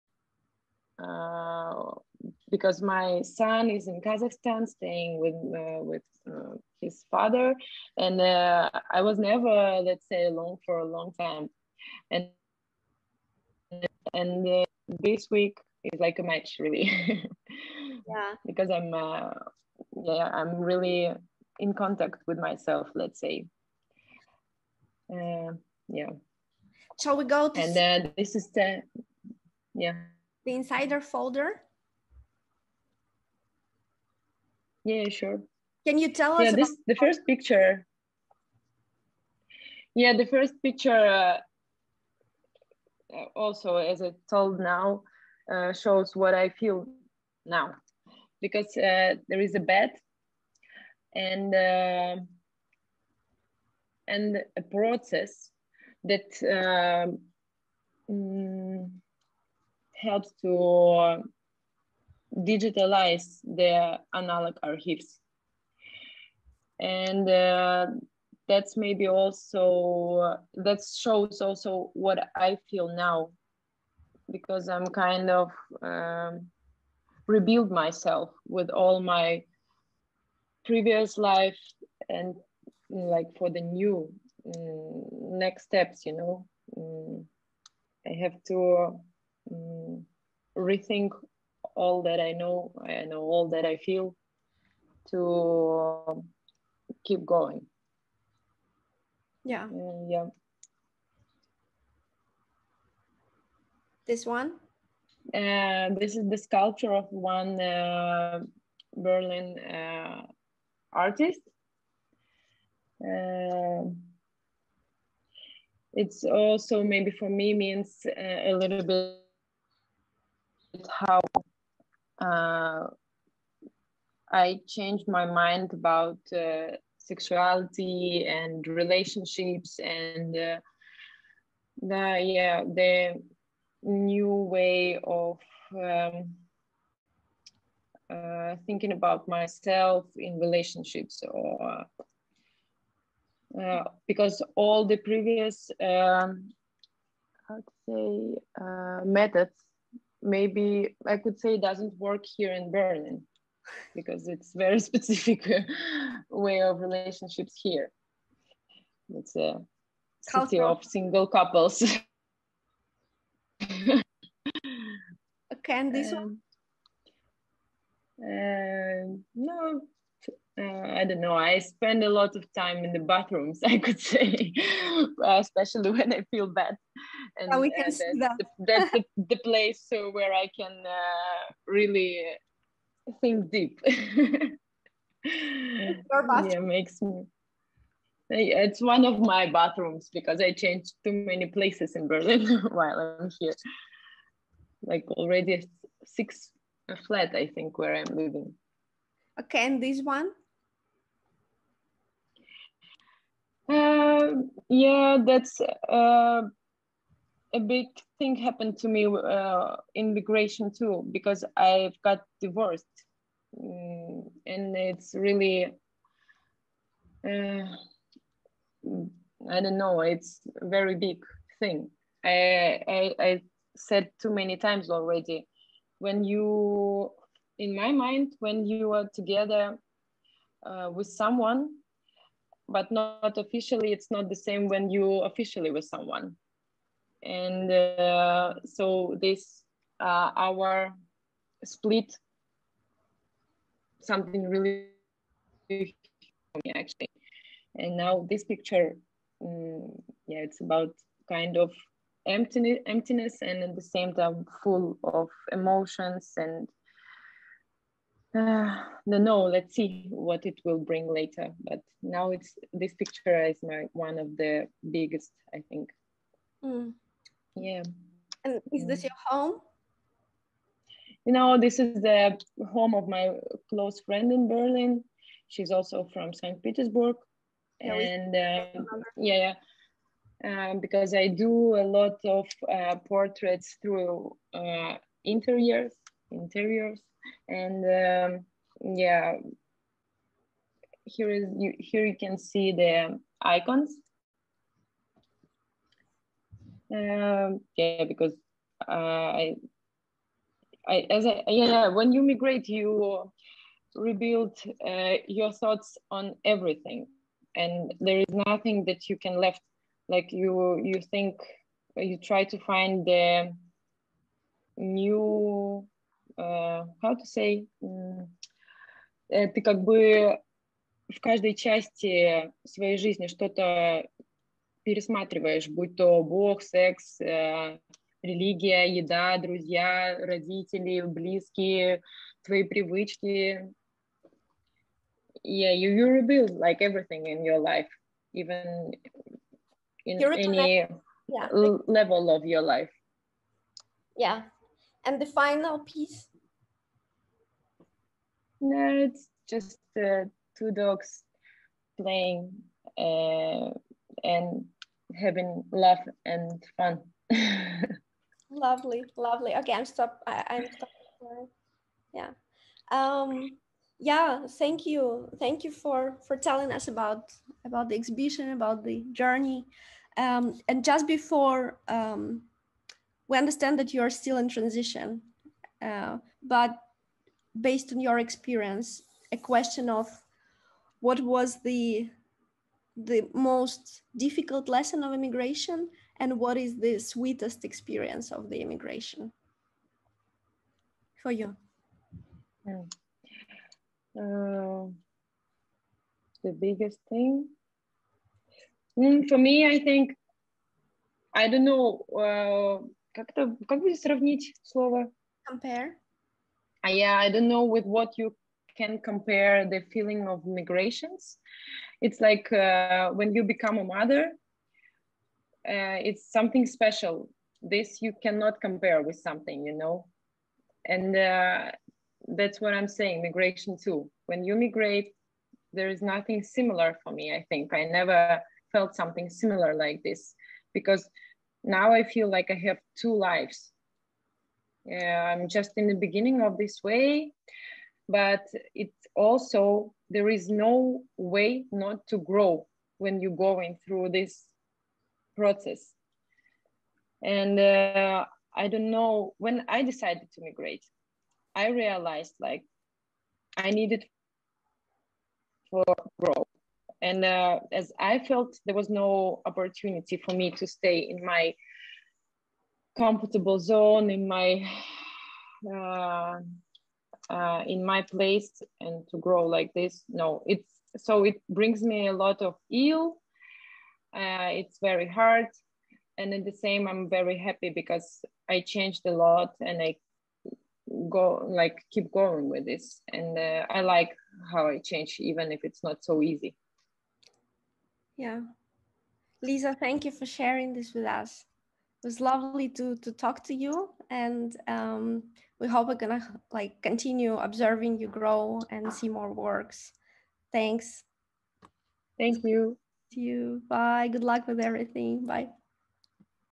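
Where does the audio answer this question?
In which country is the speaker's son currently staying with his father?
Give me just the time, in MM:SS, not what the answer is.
00:04.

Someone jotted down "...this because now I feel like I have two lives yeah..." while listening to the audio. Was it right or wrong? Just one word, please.
right.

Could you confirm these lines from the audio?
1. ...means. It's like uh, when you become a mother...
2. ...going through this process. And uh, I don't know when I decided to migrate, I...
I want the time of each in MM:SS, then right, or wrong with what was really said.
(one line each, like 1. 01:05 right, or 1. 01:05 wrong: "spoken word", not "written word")
1. 06:50 wrong: "migrations", not "means"
2. 07:23 right.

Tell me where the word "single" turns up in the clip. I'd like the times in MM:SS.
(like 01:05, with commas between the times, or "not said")
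02:40.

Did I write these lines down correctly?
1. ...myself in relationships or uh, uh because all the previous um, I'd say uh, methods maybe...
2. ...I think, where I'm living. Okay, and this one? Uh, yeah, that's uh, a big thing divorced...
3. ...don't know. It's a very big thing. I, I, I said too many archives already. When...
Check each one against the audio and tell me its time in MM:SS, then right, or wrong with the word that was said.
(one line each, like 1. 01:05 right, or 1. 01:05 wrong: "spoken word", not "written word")
1. 02:19 right
2. 03:17 wrong: "happened", not "divorced"
3. 03:39 wrong: "times", not "archives".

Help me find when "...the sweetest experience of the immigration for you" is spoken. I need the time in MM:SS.
06:26.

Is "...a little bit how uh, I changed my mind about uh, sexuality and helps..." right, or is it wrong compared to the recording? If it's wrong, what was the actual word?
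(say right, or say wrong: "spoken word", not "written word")
wrong: "relationships", not "helps".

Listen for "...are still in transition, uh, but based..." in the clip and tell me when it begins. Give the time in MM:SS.
06:14.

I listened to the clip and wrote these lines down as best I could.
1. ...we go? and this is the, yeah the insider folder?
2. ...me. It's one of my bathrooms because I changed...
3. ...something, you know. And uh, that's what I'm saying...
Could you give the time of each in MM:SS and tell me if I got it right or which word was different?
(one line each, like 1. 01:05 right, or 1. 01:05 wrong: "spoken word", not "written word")
1. 00:27 right
2. 03:07 right
3. 06:59 right.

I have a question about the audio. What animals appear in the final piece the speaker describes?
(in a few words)
Two dogs.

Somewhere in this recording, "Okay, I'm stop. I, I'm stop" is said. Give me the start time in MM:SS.
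05:59.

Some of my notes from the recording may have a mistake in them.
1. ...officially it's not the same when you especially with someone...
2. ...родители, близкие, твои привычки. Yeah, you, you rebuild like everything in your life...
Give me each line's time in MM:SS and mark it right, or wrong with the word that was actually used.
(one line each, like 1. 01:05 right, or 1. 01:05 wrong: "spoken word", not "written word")
1. 03:53 wrong: "officially", not "especially"
2. 05:30 right.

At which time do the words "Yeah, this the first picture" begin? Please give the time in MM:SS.
00:36.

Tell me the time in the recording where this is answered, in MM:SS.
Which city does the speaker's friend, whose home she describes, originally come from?
04:36.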